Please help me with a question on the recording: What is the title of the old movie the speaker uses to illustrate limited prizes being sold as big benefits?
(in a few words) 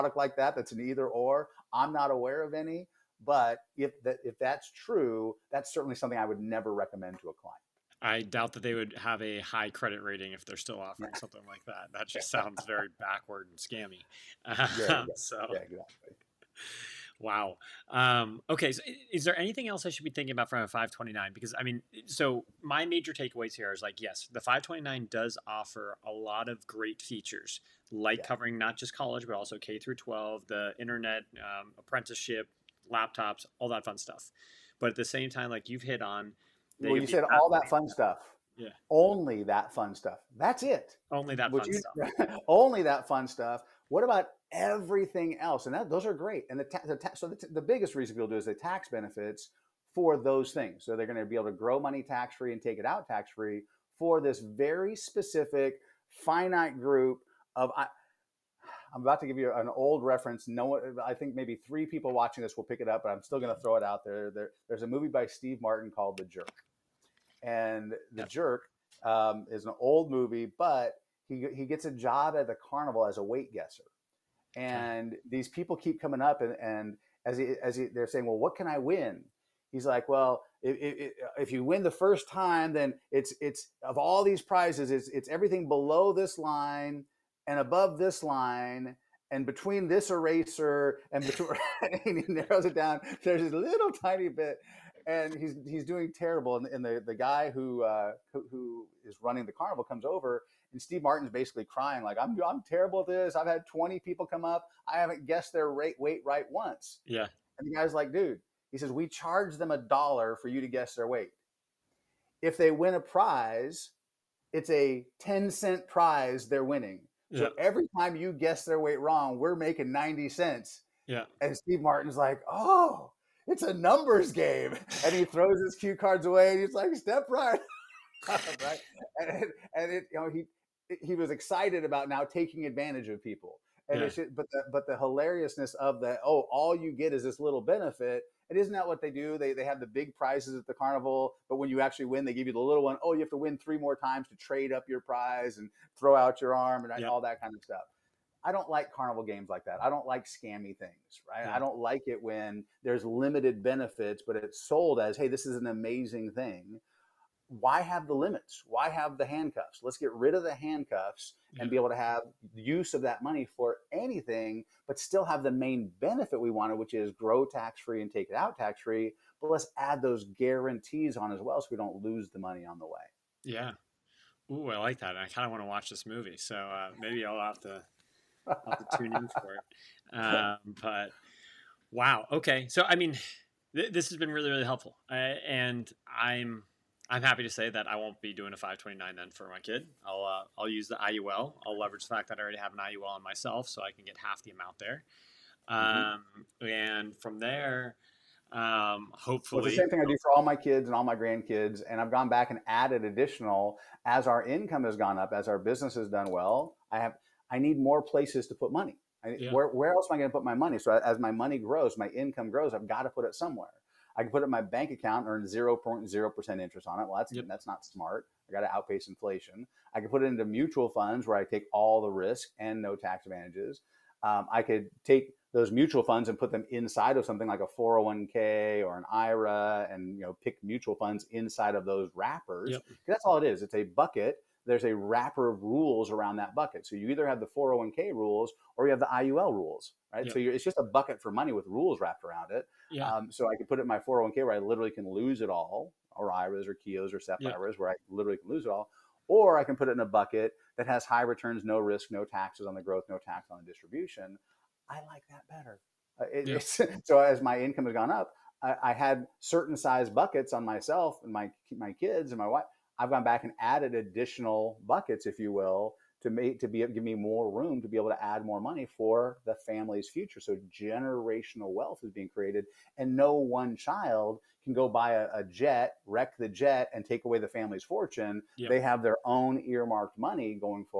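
The Jerk.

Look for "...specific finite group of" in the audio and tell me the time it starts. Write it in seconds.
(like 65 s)
54 s.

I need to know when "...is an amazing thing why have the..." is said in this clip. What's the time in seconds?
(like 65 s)
155 s.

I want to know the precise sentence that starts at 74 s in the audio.
And these people keep coming up and, and as, he, as he, they're saying, well, what can I win?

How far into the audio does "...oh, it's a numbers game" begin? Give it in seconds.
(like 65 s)
122 s.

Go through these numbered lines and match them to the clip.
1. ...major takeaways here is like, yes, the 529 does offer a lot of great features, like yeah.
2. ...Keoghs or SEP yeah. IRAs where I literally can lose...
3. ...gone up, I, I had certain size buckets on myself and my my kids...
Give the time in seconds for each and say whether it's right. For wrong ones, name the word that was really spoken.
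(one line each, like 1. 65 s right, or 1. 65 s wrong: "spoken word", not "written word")
1. 22 s right
2. 246 s right
3. 257 s right.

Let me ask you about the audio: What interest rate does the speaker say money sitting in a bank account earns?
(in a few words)
0.0%.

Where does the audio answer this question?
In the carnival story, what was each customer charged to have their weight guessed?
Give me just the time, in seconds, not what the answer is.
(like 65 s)
109 s.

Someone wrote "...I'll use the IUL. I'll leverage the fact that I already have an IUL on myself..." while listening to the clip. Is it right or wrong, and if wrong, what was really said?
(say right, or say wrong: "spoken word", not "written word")
right.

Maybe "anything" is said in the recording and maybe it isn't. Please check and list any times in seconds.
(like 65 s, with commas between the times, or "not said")
19 s, 163 s.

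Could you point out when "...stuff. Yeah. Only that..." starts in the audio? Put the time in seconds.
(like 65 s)
37 s.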